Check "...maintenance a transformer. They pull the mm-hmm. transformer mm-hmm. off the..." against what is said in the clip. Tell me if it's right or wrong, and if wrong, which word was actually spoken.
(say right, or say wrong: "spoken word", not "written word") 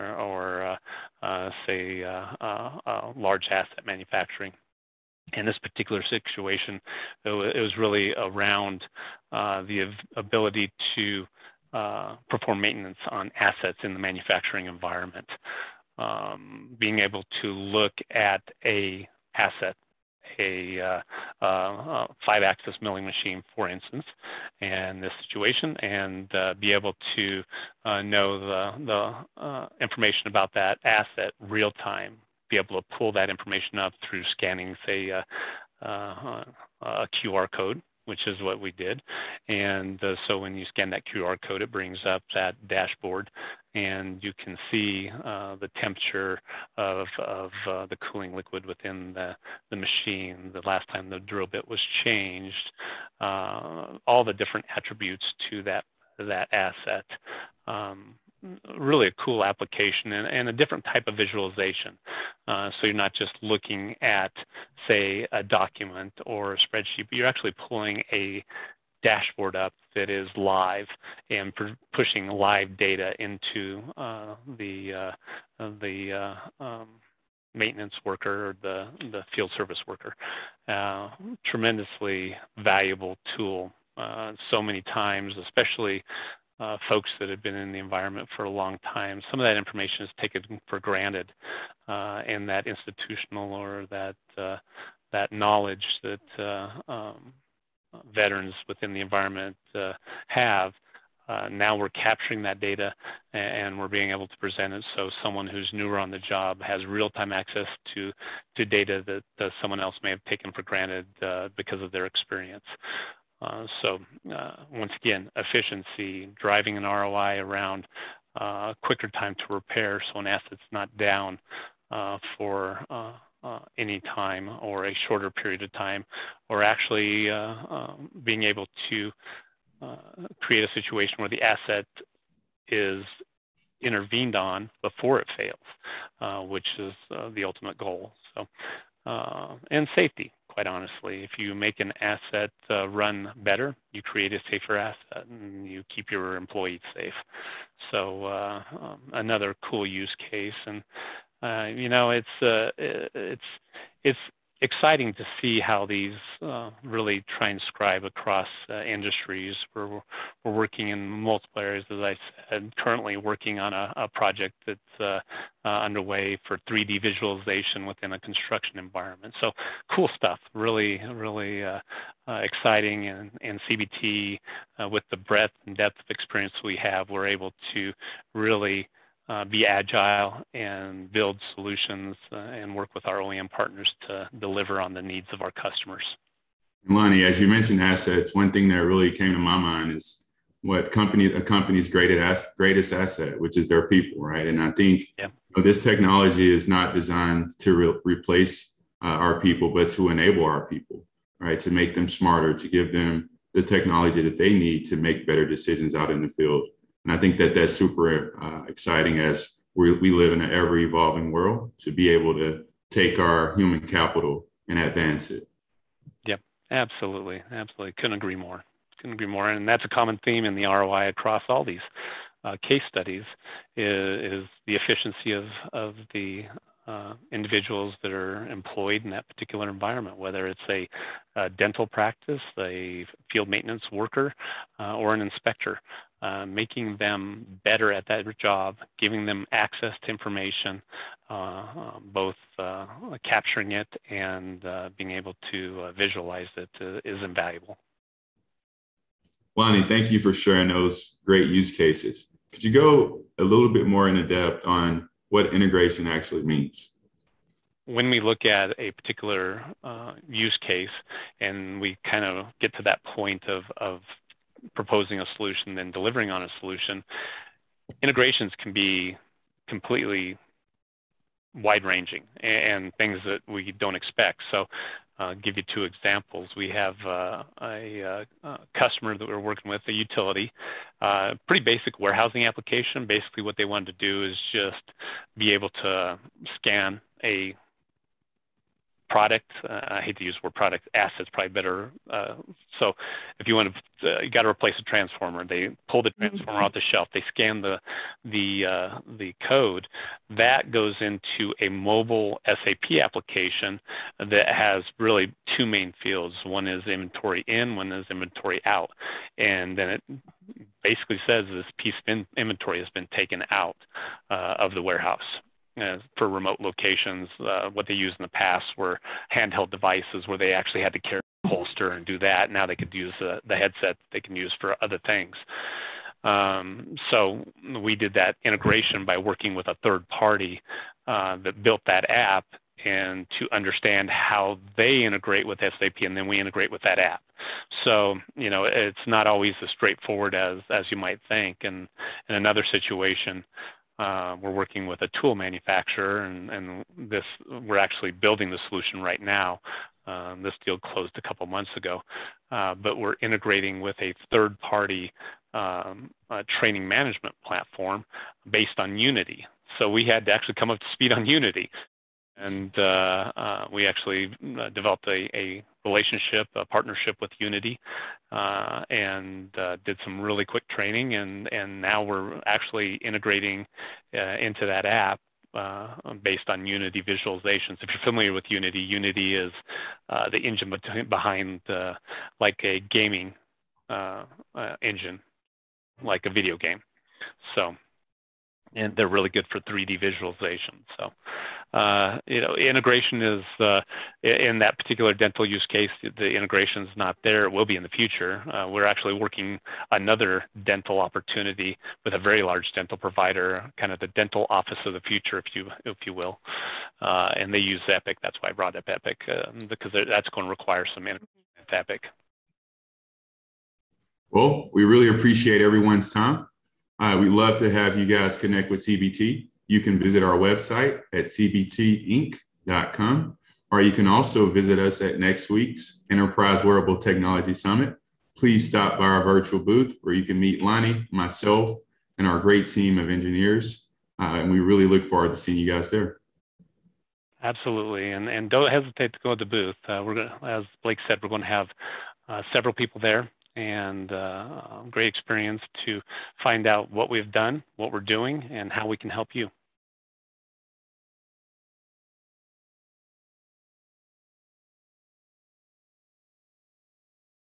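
wrong: "replace", not "maintenance".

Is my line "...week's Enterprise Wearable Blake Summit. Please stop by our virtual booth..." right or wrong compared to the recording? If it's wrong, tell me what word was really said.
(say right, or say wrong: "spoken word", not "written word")
wrong: "Technology", not "Blake".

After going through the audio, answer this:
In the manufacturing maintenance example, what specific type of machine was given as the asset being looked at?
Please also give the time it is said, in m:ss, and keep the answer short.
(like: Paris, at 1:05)
Five axis milling machine, at 0:22.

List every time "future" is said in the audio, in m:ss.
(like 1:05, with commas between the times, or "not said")
6:37, 6:45.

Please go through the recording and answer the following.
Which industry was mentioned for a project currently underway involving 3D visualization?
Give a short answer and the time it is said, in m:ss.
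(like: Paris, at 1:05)
Construction, at 2:48.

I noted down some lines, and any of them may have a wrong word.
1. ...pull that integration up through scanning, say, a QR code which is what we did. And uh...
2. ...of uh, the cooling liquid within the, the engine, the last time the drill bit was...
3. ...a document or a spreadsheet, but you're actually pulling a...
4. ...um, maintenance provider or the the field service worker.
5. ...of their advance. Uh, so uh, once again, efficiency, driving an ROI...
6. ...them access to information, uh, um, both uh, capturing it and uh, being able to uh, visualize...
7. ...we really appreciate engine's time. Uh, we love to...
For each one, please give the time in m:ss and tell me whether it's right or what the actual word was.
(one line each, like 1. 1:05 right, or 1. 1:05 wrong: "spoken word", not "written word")
1. 0:32 wrong: "information", not "integration"
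2. 0:47 wrong: "machine", not "engine"
3. 1:05 right
4. 1:16 wrong: "worker", not "provider"
5. 1:51 wrong: "experience", not "advance"
6. 3:59 right
7. 6:54 wrong: "everyone", not "engine".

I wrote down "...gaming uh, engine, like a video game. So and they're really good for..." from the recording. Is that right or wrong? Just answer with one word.
right.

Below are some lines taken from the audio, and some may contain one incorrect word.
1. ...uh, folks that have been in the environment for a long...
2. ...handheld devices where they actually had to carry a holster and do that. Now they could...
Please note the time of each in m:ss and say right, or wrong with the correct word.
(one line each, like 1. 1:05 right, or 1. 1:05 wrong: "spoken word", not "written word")
1. 1:26 right
2. 5:19 right.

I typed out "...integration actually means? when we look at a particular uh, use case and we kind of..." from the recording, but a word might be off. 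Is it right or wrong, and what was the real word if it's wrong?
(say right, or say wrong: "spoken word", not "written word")
right.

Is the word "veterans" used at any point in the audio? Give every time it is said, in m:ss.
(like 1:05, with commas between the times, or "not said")
1:38.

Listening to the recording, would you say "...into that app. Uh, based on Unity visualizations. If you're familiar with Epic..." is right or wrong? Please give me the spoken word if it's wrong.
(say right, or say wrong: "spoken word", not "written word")
wrong: "Unity", not "Epic".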